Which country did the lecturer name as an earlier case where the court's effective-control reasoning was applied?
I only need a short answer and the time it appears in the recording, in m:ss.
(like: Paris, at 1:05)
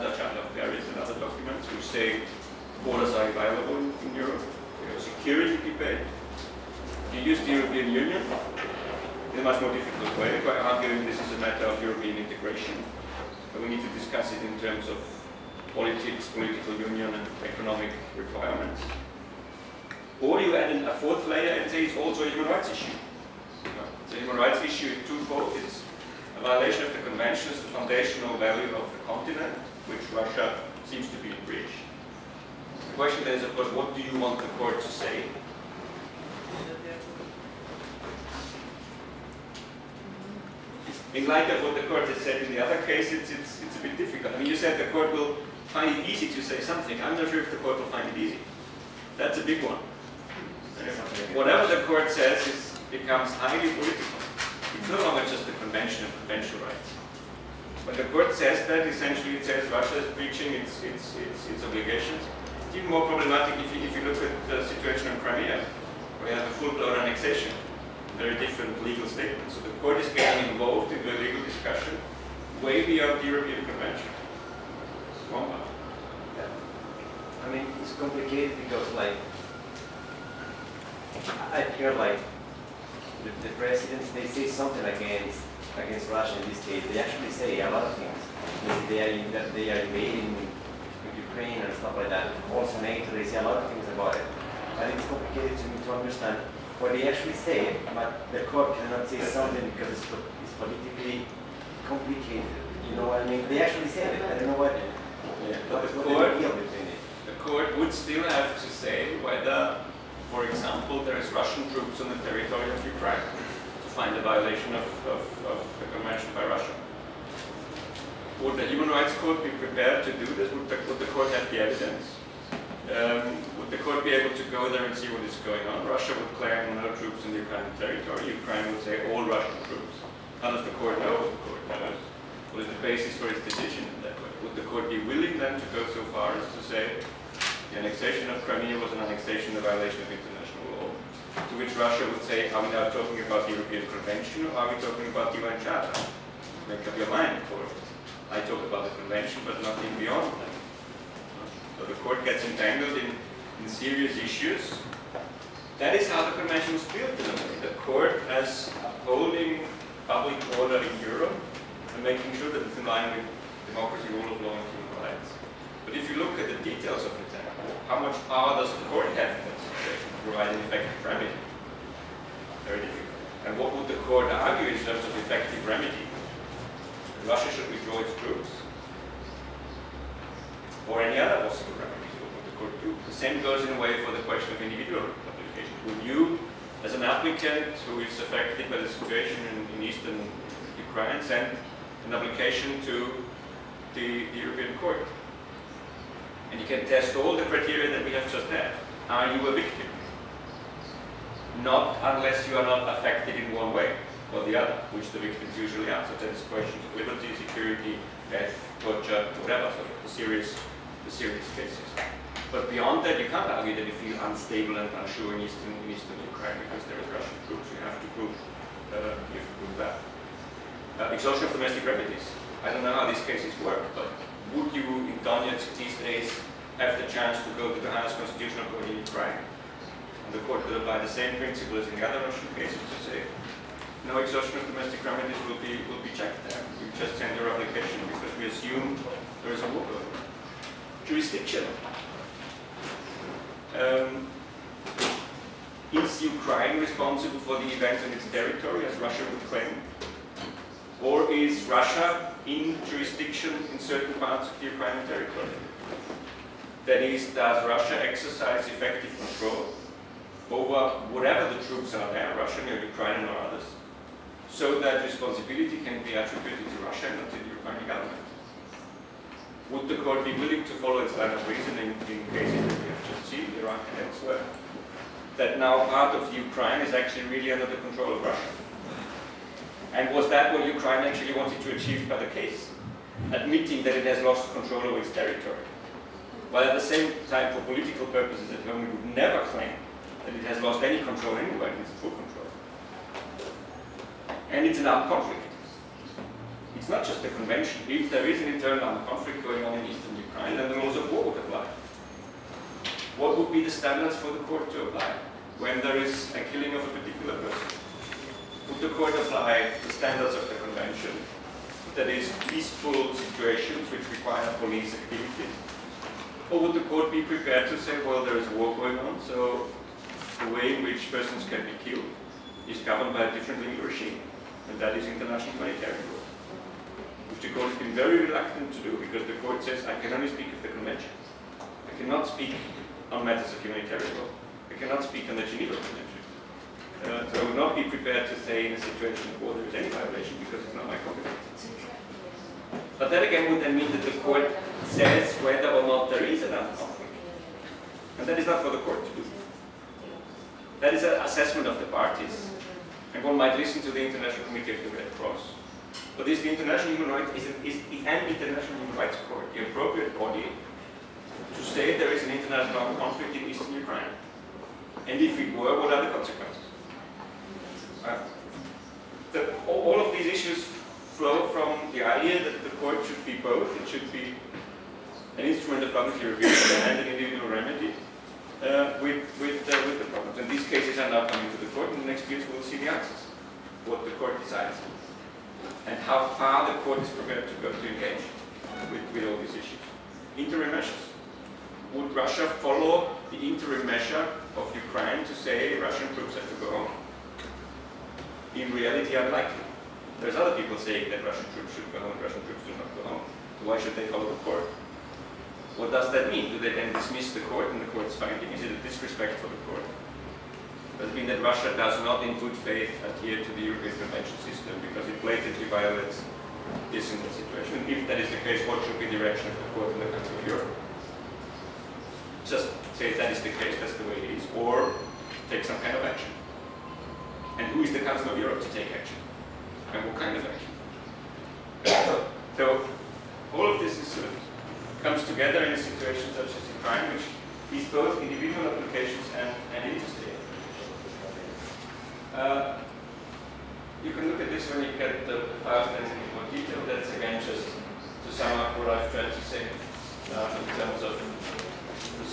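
Iraq, at 4:33.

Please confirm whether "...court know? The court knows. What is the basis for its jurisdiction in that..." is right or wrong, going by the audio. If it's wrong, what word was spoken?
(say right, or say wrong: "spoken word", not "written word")
wrong: "decision", not "jurisdiction".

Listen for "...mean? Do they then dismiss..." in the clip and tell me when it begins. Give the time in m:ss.
6:46.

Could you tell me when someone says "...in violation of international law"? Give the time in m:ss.
2:19.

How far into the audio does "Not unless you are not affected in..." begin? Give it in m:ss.
3:21.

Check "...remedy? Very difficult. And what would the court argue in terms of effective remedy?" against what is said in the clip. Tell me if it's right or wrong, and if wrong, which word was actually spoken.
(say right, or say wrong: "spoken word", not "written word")
right.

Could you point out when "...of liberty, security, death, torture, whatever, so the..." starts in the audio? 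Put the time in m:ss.
3:26.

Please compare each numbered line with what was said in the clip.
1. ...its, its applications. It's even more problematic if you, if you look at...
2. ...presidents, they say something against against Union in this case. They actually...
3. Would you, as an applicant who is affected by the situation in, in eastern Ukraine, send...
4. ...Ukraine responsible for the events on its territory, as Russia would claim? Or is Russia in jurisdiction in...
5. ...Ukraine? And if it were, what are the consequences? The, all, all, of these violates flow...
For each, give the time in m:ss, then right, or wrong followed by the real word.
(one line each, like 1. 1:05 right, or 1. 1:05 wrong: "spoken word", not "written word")
1. 1:01 wrong: "obligations", not "applications"
2. 1:23 wrong: "Russia", not "Union"
3. 3:05 right
4. 4:06 right
5. 6:03 wrong: "issues", not "violates".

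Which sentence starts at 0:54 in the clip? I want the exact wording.
It's no longer just the convention of conventional rights.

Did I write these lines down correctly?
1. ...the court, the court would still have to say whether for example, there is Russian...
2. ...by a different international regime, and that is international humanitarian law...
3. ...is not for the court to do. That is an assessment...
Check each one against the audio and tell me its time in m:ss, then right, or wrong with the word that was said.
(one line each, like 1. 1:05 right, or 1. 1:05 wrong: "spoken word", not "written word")
1. 1:45 right
2. 5:23 wrong: "legal", not "international"
3. 5:48 right.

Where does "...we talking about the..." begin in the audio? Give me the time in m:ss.
2:24.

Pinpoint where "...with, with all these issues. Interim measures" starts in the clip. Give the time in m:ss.
6:28.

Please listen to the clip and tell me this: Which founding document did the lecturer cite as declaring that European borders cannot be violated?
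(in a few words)
Charter of Paris.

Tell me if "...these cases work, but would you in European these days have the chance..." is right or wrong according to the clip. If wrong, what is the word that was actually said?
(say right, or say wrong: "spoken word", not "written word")
wrong: "Donetsk", not "European".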